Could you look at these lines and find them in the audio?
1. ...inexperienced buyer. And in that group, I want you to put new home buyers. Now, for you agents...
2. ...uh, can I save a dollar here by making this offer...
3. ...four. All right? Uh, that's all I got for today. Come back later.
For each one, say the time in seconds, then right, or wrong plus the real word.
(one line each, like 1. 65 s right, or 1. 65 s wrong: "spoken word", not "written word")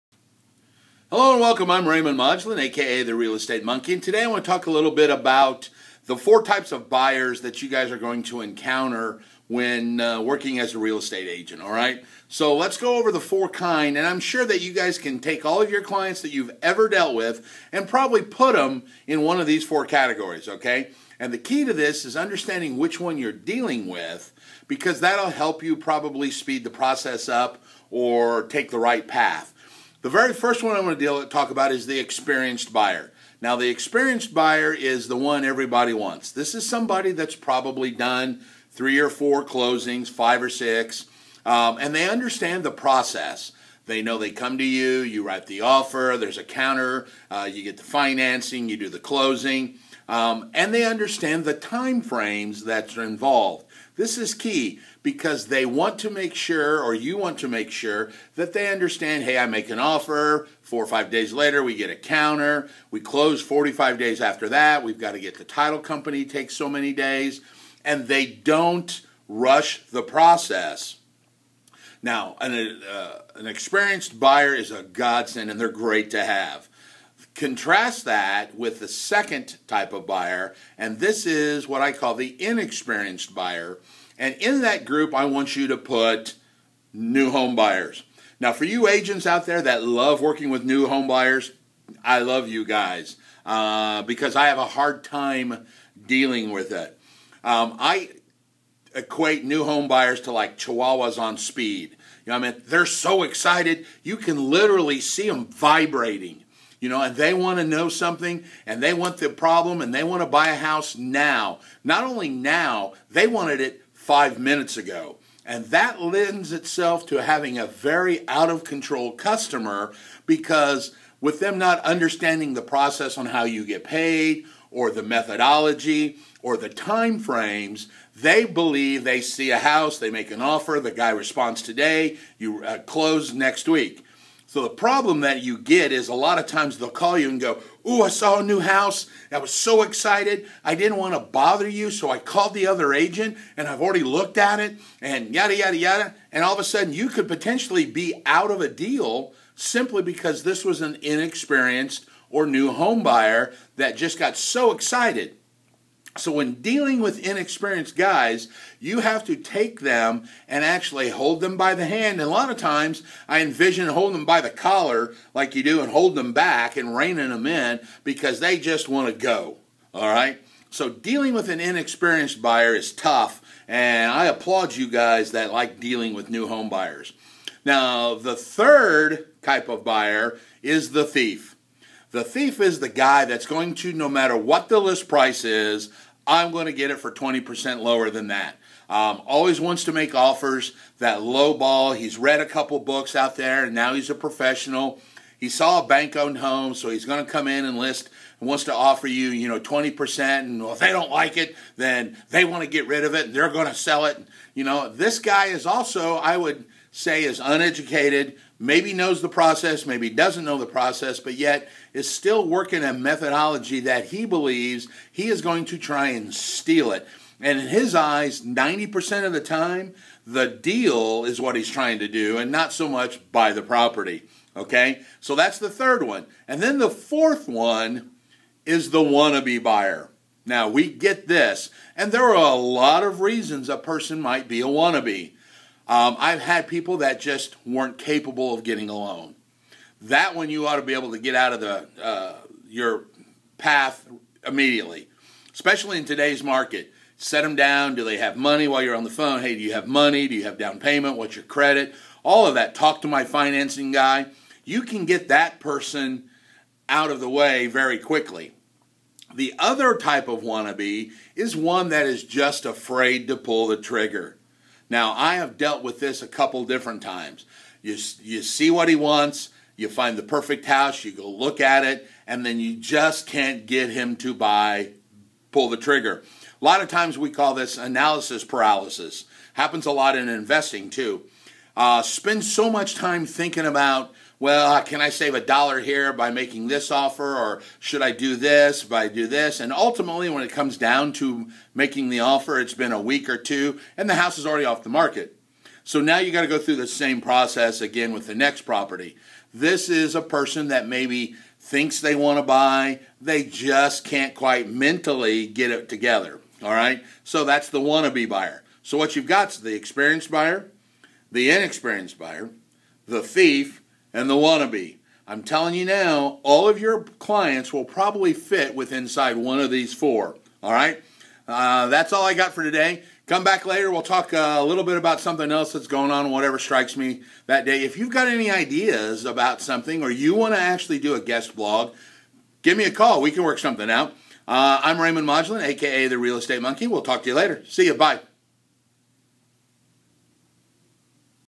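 1. 82 s right
2. 284 s right
3. 319 s right.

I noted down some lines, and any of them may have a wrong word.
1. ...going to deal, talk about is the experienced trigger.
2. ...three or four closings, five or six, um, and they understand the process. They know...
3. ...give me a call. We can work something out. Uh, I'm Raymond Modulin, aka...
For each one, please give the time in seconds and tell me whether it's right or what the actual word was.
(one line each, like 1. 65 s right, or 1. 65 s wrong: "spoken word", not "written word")
1. 30 s wrong: "buyer", not "trigger"
2. 38 s right
3. 332 s right.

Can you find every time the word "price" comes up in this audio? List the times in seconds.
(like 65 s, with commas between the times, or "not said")
185 s.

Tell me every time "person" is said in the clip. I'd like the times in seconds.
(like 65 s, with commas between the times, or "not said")
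233 s, 255 s, 300 s.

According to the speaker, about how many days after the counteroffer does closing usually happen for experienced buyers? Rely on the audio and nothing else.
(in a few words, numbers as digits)
45.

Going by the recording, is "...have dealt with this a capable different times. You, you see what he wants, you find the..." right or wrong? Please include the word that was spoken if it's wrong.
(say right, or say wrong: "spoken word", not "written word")
wrong: "couple", not "capable".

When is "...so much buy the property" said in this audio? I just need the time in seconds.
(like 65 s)
222 s.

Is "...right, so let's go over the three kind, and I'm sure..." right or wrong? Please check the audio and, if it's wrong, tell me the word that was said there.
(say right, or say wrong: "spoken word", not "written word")
wrong: "four", not "three".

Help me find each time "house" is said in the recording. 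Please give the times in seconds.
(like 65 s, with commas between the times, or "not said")
110 s, 129 s, 138 s, 270 s, 294 s.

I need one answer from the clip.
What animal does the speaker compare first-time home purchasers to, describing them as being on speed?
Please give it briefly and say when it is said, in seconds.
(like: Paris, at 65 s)
Chihuahuas, at 100 s.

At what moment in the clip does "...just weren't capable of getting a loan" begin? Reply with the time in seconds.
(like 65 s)
237 s.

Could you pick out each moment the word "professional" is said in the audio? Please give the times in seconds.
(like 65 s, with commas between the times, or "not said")
194 s.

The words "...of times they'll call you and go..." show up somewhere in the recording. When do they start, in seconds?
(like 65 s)
136 s.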